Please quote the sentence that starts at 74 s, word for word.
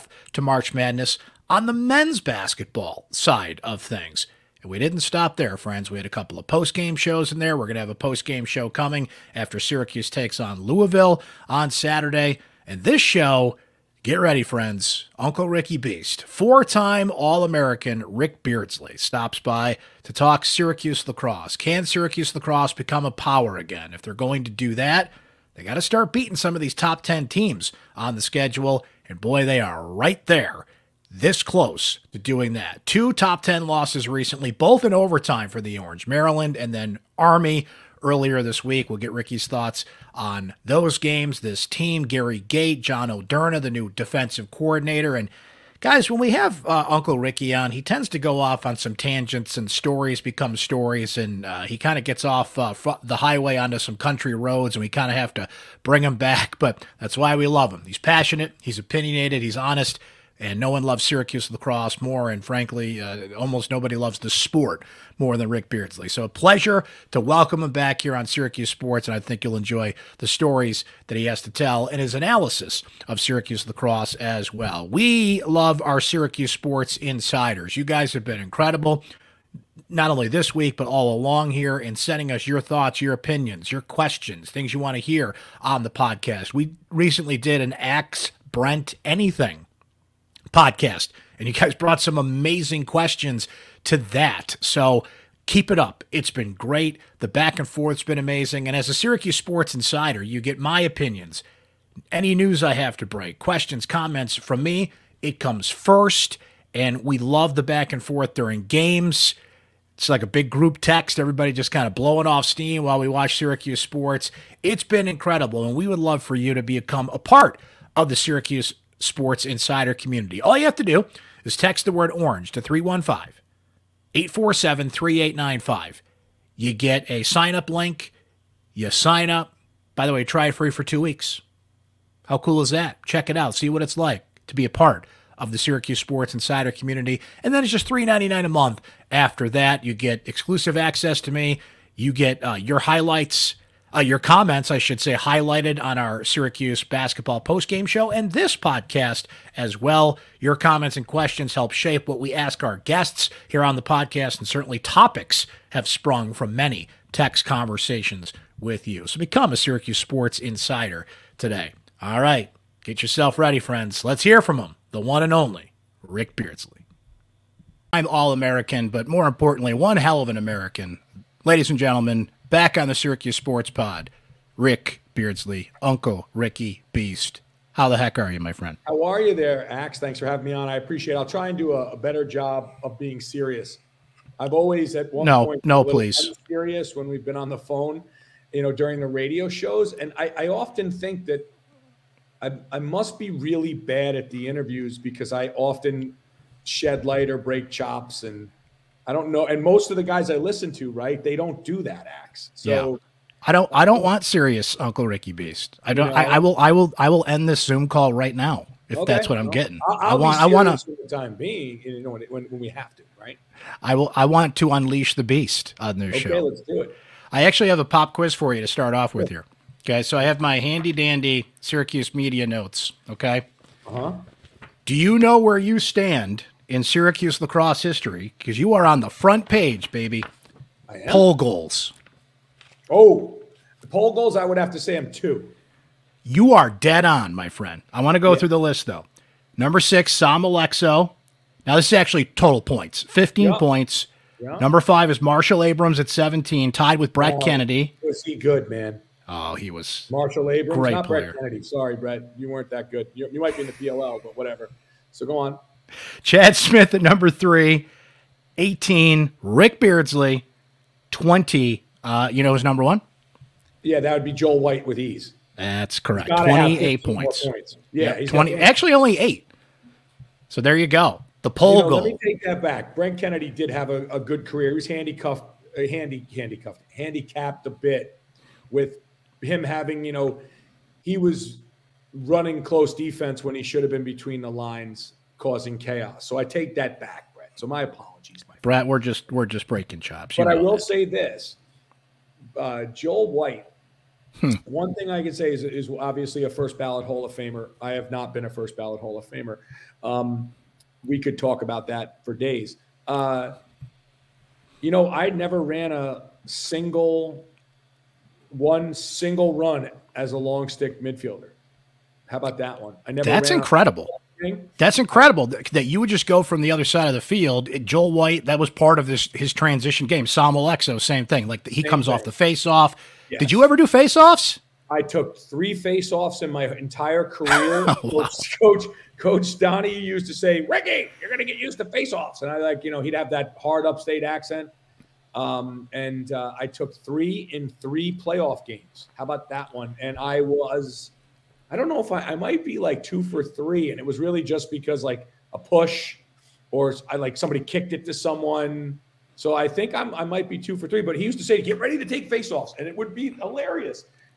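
We love our Syracuse Sports insiders.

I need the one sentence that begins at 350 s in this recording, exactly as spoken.
But he used to say, "Get ready to take faceoffs," and it would be hilarious.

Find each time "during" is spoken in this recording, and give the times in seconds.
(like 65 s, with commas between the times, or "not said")
108 s, 188 s.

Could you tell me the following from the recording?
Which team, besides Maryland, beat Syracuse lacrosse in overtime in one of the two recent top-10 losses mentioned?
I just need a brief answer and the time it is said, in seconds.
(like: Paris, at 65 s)
Army, at 37 s.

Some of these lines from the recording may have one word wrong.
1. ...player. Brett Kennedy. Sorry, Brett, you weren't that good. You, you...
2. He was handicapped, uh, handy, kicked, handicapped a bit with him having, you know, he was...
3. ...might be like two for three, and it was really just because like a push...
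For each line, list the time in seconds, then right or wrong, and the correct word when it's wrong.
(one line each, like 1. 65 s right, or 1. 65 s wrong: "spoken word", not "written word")
1. 251 s right
2. 274 s wrong: "handcuffed", not "kicked"
3. 342 s right.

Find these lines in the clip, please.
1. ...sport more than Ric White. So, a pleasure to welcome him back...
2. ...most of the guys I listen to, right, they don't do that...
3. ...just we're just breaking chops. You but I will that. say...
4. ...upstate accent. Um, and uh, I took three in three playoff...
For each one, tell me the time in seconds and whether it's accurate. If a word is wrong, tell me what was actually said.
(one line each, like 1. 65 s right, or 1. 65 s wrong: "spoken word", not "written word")
1. 64 s wrong: "Beardsley", not "White"
2. 199 s right
3. 288 s right
4. 333 s right.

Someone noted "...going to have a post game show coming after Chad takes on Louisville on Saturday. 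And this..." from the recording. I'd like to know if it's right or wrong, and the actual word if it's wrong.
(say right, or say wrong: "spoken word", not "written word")
wrong: "Syracuse", not "Chad".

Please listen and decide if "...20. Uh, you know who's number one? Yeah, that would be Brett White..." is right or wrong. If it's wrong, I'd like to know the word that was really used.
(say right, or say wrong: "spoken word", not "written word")
wrong: "Joel", not "Brett".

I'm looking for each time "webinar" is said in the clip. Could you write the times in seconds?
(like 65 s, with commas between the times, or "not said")
not said.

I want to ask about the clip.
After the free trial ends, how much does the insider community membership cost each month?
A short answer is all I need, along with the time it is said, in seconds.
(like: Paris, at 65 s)
$3.99, at 137 s.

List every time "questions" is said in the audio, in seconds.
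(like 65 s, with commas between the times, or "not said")
83 s, 92 s, 103 s, 151 s.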